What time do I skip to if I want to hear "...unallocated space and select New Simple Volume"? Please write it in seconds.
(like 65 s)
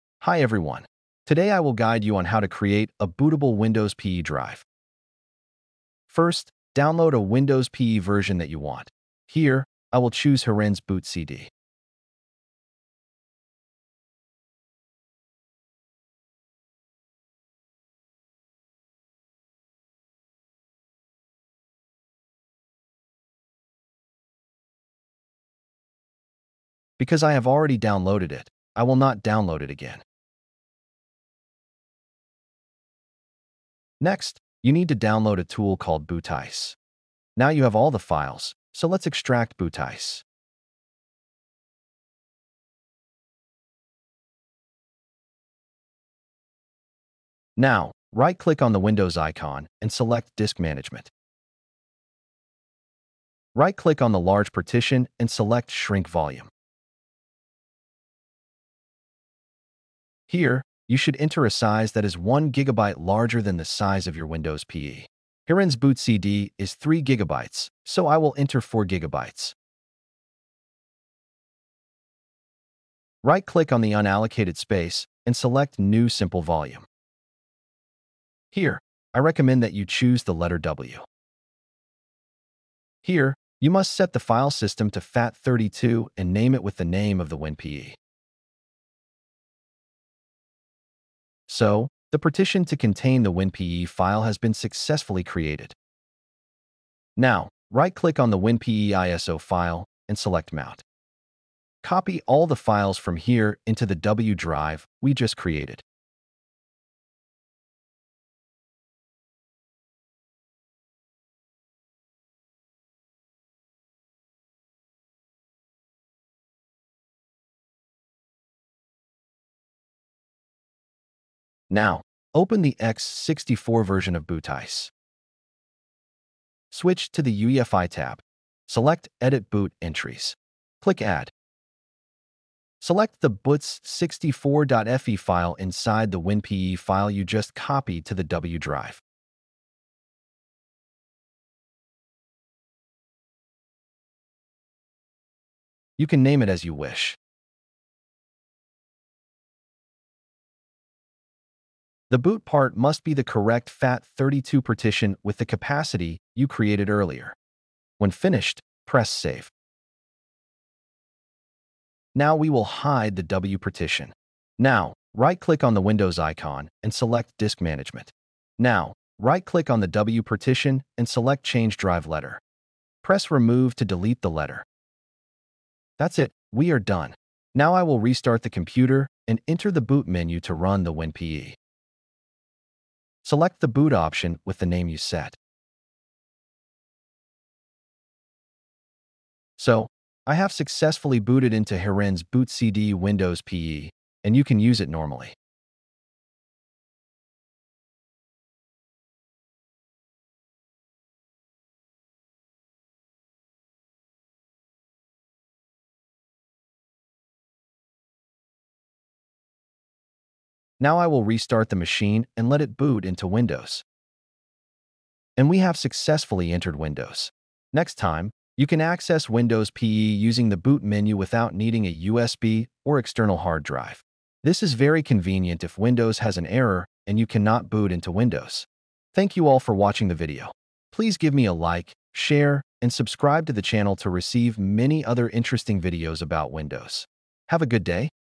73 s.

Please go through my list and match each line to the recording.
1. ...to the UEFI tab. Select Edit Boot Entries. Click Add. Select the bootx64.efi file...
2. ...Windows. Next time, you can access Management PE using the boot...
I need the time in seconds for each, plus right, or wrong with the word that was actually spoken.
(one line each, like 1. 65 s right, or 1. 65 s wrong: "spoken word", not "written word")
1. 127 s right
2. 216 s wrong: "Windows", not "Management".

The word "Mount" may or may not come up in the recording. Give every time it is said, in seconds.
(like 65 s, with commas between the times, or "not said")
100 s.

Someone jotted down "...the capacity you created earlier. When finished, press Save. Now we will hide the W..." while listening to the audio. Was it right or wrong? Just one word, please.
right.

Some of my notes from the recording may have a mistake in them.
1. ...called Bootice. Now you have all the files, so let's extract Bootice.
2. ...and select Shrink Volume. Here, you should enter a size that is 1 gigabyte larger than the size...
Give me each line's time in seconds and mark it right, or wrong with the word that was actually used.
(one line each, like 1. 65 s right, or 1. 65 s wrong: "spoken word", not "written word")
1. 35 s right
2. 55 s right.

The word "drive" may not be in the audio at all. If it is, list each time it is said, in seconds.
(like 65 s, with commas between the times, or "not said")
4 s, 104 s, 138 s, 171 s, 223 s.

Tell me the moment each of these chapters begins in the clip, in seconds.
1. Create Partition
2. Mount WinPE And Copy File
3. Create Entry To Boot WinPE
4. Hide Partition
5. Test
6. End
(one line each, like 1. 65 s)
1. 65 s
2. 115 s
3. 139 s
4. 181 s
5. 195 s
6. 229 s.